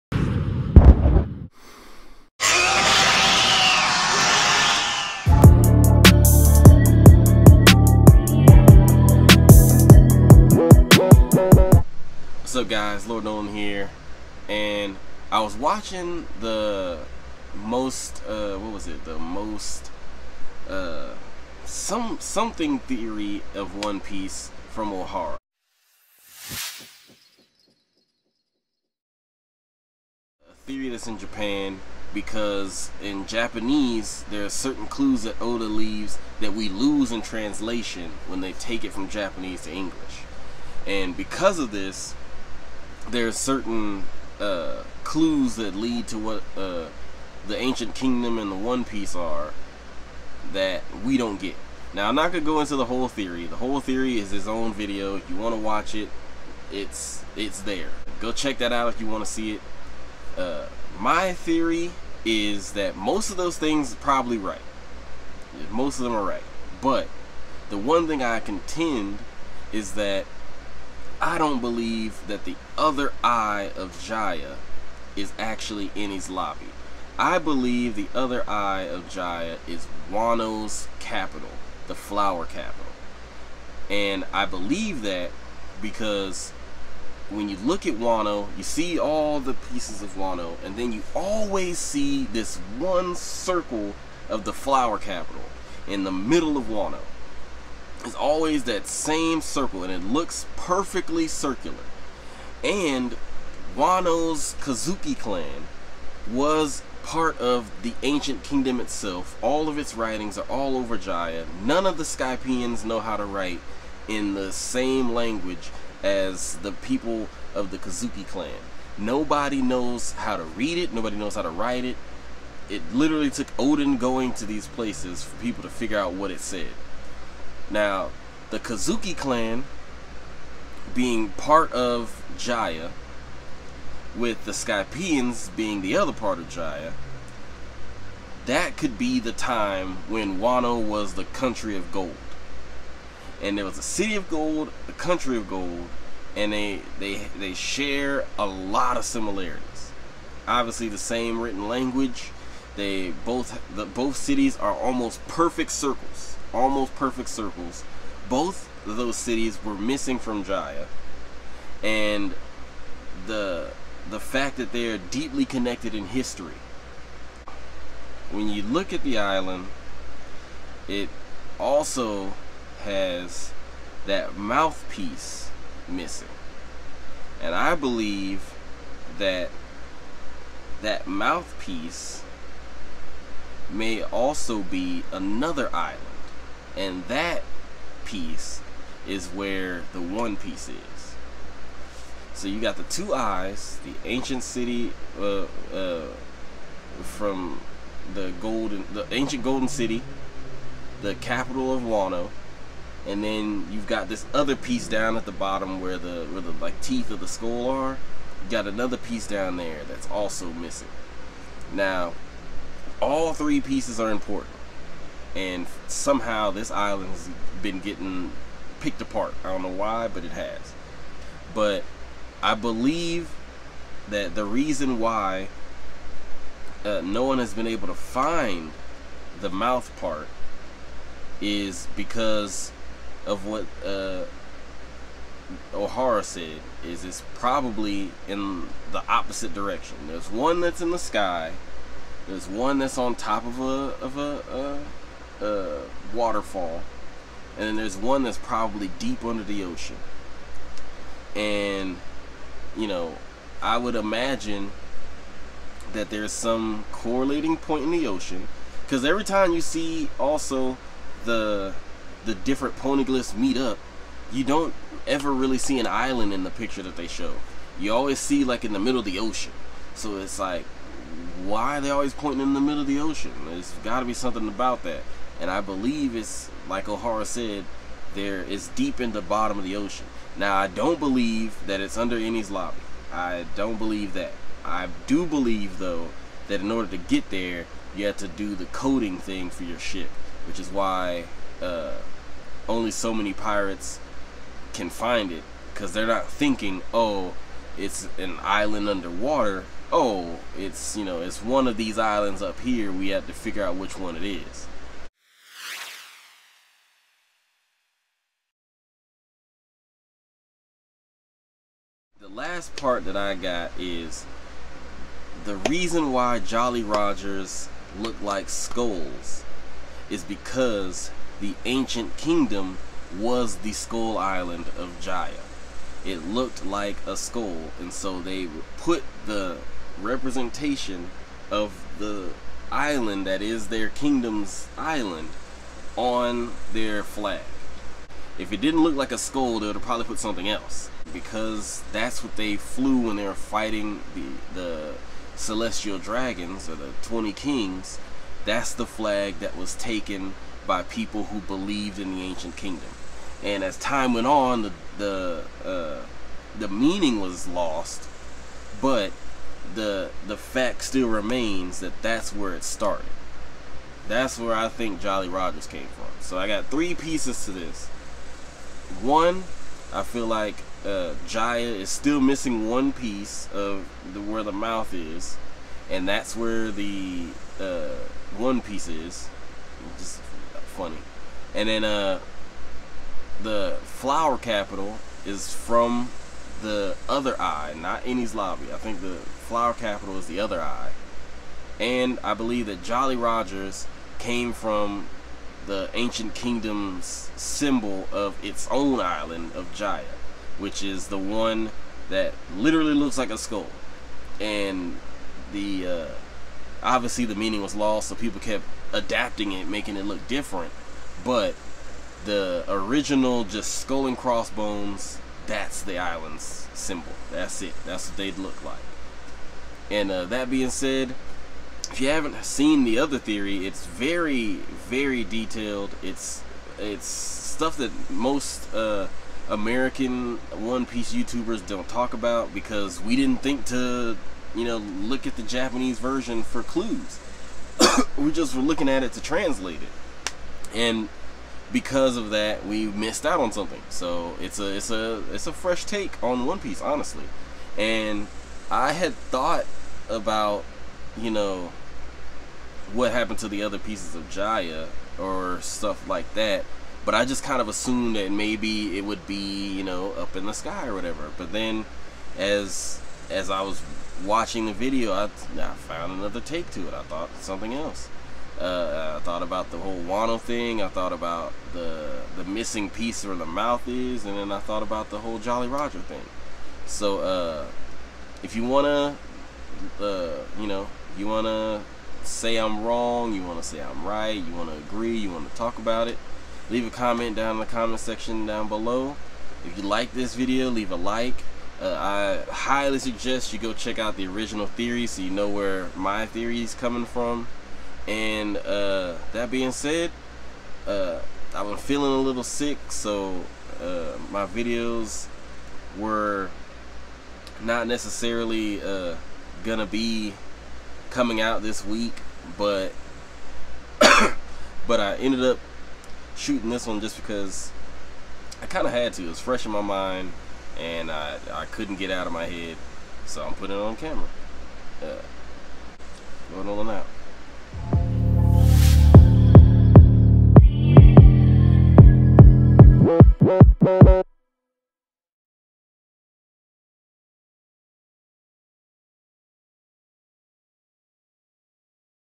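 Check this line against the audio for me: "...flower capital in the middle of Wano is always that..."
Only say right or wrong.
right.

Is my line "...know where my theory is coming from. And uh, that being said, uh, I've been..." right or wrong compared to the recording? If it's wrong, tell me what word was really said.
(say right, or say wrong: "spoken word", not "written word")
right.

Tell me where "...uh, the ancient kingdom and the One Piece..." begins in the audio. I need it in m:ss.
0:46.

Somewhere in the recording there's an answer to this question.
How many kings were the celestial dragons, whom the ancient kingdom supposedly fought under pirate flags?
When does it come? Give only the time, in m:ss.
5:47.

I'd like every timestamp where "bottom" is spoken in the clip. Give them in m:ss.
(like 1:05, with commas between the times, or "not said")
3:25, 4:39.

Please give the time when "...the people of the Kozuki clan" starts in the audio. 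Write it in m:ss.
1:56.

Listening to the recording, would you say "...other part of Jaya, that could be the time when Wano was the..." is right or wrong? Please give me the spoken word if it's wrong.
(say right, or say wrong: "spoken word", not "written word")
right.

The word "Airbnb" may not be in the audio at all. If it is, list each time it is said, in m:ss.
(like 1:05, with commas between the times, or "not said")
not said.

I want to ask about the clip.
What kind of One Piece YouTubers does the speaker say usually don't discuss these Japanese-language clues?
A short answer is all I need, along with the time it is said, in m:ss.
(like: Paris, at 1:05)
American, at 7:09.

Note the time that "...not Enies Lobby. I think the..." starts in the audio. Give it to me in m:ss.
6:27.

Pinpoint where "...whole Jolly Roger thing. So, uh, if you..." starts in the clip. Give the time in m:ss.
7:55.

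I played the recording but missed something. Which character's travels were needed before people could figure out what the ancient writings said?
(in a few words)
Oden.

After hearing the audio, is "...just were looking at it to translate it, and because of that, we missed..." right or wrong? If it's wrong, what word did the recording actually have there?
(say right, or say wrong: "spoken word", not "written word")
right.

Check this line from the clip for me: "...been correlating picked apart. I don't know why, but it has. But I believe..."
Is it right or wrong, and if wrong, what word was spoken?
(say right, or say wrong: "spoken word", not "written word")
wrong: "getting", not "correlating".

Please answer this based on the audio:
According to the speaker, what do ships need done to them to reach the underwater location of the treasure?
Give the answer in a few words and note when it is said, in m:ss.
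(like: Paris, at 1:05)
Coating, at 4:48.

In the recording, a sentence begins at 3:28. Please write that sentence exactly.
You got another piece down there that's also missing.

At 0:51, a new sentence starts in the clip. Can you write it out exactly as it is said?
Now I'm not gonna go into the whole theory.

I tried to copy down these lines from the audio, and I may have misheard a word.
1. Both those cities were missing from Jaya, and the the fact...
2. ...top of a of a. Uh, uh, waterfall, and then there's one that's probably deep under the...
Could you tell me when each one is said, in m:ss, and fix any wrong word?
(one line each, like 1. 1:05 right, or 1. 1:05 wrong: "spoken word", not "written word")
1. 2:38 right
2. 4:03 right.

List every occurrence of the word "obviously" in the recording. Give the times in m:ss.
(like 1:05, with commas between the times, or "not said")
2:30, 6:46.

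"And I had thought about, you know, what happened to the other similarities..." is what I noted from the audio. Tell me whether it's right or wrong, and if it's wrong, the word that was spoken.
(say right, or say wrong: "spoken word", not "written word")
wrong: "pieces", not "similarities".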